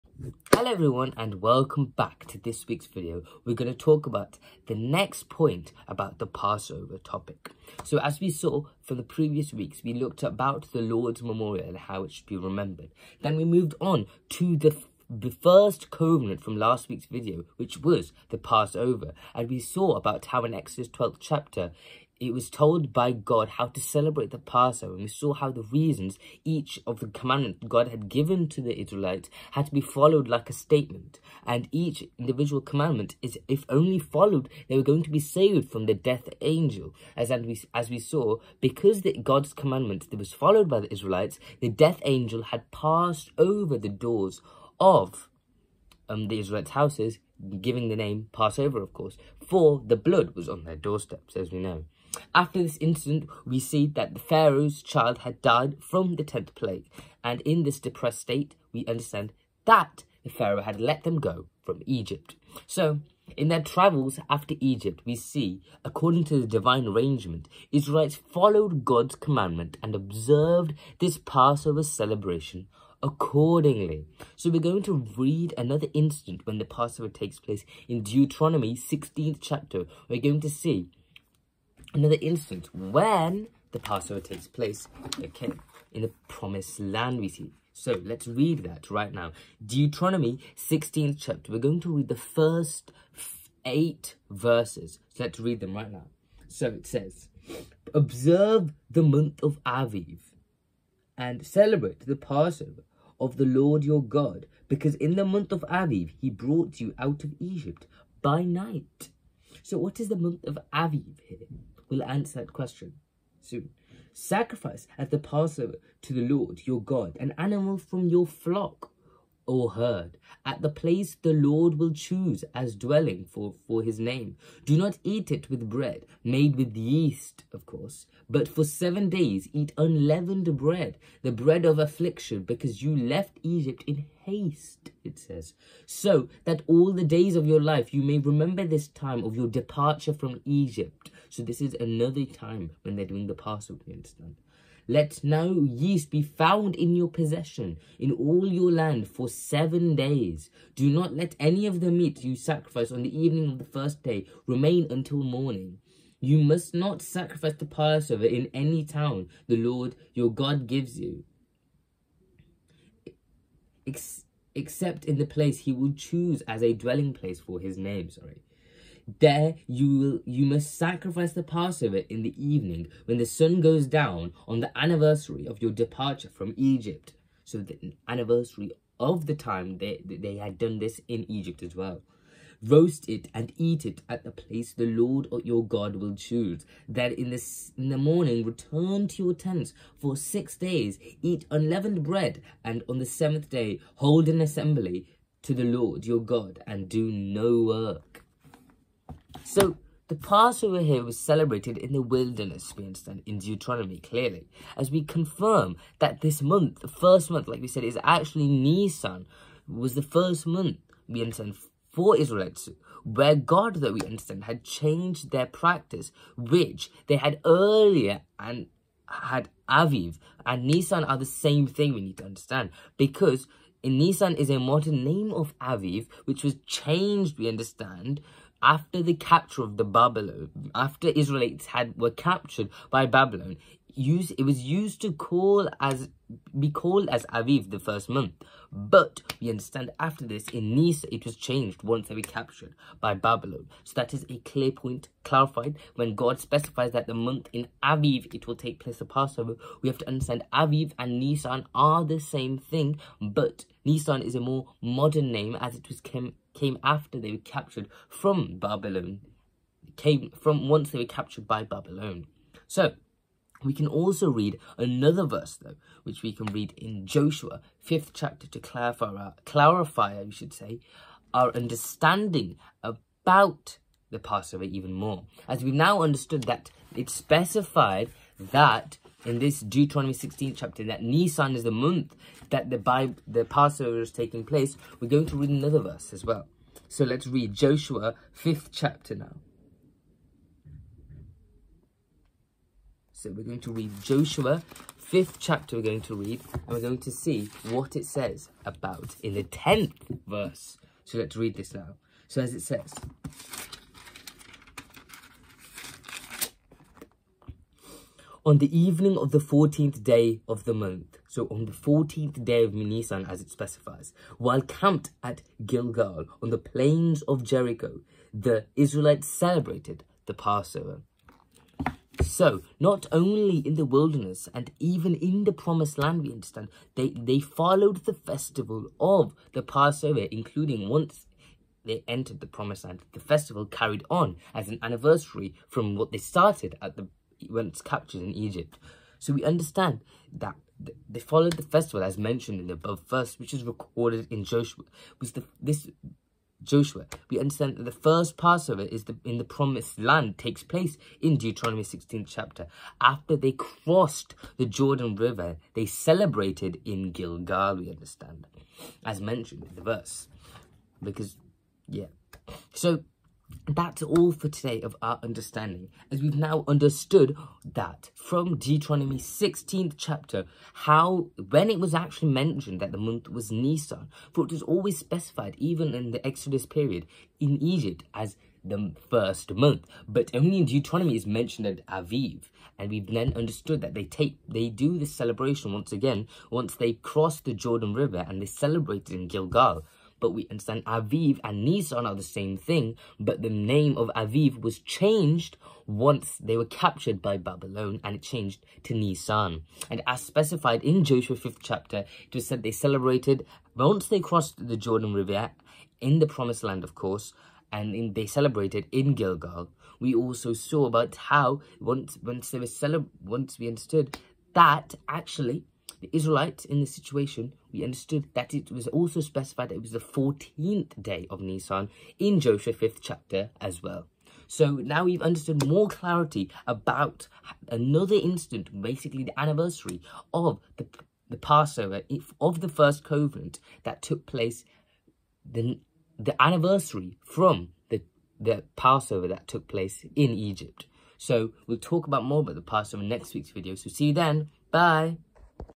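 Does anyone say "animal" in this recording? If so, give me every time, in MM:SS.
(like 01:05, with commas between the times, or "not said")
01:57.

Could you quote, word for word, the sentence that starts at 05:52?
After they crossed the Jordan River, they celebrated in Gilgal, we understand, as mentioned in the verse.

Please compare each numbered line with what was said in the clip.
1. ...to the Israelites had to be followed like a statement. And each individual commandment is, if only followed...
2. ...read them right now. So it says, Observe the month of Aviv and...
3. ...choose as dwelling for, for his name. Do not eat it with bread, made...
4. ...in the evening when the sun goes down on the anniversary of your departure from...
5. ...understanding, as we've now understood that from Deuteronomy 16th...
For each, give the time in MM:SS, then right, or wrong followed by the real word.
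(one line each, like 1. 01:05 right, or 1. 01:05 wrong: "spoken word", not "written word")
1. 00:28 right
2. 01:35 right
3. 02:01 right
4. 02:52 right
5. 06:05 right.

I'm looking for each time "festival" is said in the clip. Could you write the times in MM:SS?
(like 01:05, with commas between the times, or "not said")
05:28, 05:33, 05:41.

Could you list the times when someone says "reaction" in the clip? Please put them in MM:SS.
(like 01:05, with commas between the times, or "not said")
not said.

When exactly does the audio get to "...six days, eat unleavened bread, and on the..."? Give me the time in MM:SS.
03:10.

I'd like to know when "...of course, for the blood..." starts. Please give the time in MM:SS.
00:48.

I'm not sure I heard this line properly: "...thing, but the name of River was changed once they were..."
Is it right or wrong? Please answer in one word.
wrong.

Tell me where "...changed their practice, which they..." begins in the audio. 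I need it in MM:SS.
03:34.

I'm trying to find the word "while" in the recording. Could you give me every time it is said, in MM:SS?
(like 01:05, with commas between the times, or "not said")
05:14.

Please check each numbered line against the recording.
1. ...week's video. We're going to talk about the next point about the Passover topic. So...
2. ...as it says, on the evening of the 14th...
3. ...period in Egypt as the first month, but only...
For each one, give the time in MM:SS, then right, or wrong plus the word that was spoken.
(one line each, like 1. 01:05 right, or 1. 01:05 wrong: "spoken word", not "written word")
1. 00:02 right
2. 05:02 right
3. 06:16 right.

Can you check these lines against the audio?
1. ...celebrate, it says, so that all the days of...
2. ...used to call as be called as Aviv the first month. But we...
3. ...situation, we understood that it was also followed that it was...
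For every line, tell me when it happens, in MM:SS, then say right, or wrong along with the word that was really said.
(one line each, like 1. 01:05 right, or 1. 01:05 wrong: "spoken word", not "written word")
1. 02:14 wrong: "haste", not "celebrate"
2. 03:54 right
3. 06:56 wrong: "specified", not "followed".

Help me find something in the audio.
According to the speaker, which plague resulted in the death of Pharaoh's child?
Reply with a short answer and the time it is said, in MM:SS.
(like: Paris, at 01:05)
10th plague, at 00:56.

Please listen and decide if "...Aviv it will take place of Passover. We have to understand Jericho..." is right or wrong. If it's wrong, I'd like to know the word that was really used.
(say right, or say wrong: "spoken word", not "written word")
wrong: "Aviv", not "Jericho".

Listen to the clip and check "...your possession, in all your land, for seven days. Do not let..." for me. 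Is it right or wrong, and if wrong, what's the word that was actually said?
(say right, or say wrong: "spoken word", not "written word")
right.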